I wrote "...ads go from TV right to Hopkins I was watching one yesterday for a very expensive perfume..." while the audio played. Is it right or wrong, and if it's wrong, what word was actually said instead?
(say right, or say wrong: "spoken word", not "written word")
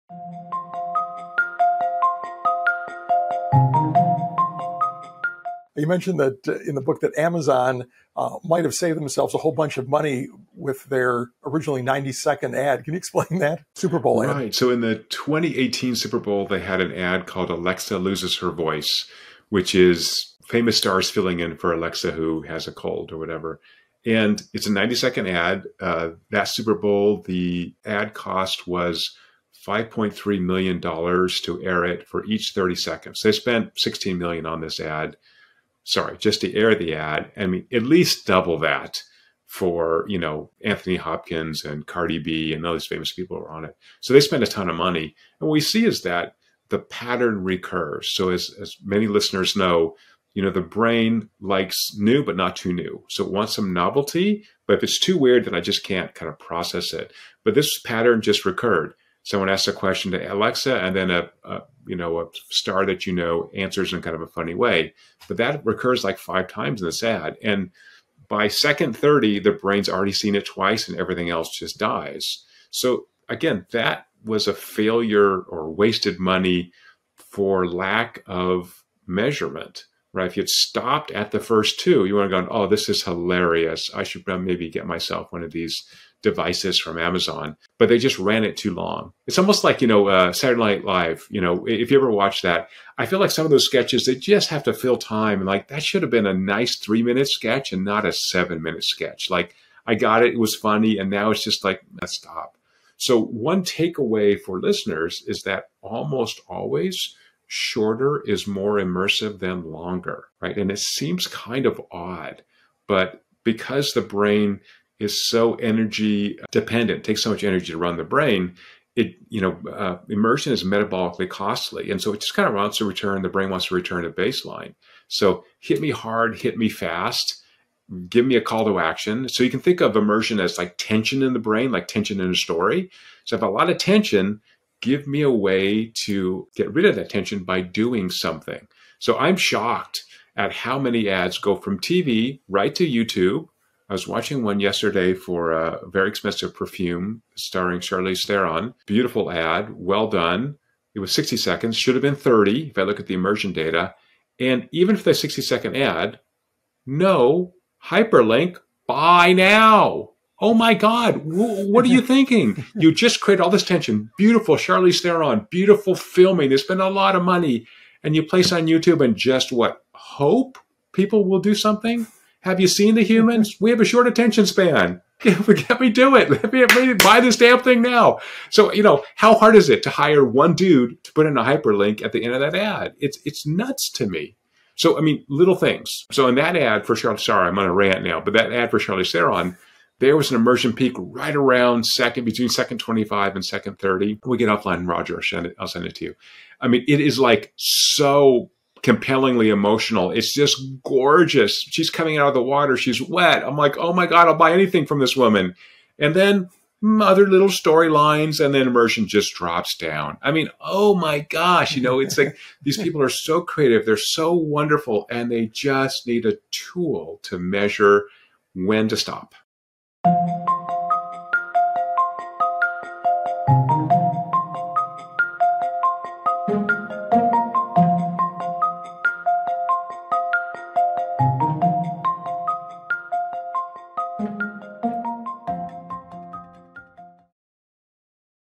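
wrong: "YouTube", not "Hopkins".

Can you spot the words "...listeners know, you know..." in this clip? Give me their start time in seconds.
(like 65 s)
49 s.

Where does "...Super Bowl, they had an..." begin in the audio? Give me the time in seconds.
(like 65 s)
15 s.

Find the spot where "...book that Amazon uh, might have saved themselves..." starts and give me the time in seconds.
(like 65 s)
6 s.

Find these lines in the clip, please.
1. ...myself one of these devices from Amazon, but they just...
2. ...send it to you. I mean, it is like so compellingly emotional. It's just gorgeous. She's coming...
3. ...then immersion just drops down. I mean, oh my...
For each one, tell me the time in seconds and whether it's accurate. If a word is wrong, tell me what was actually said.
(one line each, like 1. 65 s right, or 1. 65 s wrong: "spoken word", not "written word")
1. 84 s right
2. 195 s right
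3. 208 s right.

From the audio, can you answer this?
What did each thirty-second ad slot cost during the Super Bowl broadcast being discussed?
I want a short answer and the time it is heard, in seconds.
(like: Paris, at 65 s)
$5.3 million, at 29 s.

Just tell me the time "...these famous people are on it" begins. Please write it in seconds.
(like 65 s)
42 s.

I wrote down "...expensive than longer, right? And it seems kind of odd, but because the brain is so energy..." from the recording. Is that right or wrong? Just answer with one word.
wrong.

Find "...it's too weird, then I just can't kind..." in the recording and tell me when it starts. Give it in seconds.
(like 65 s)
54 s.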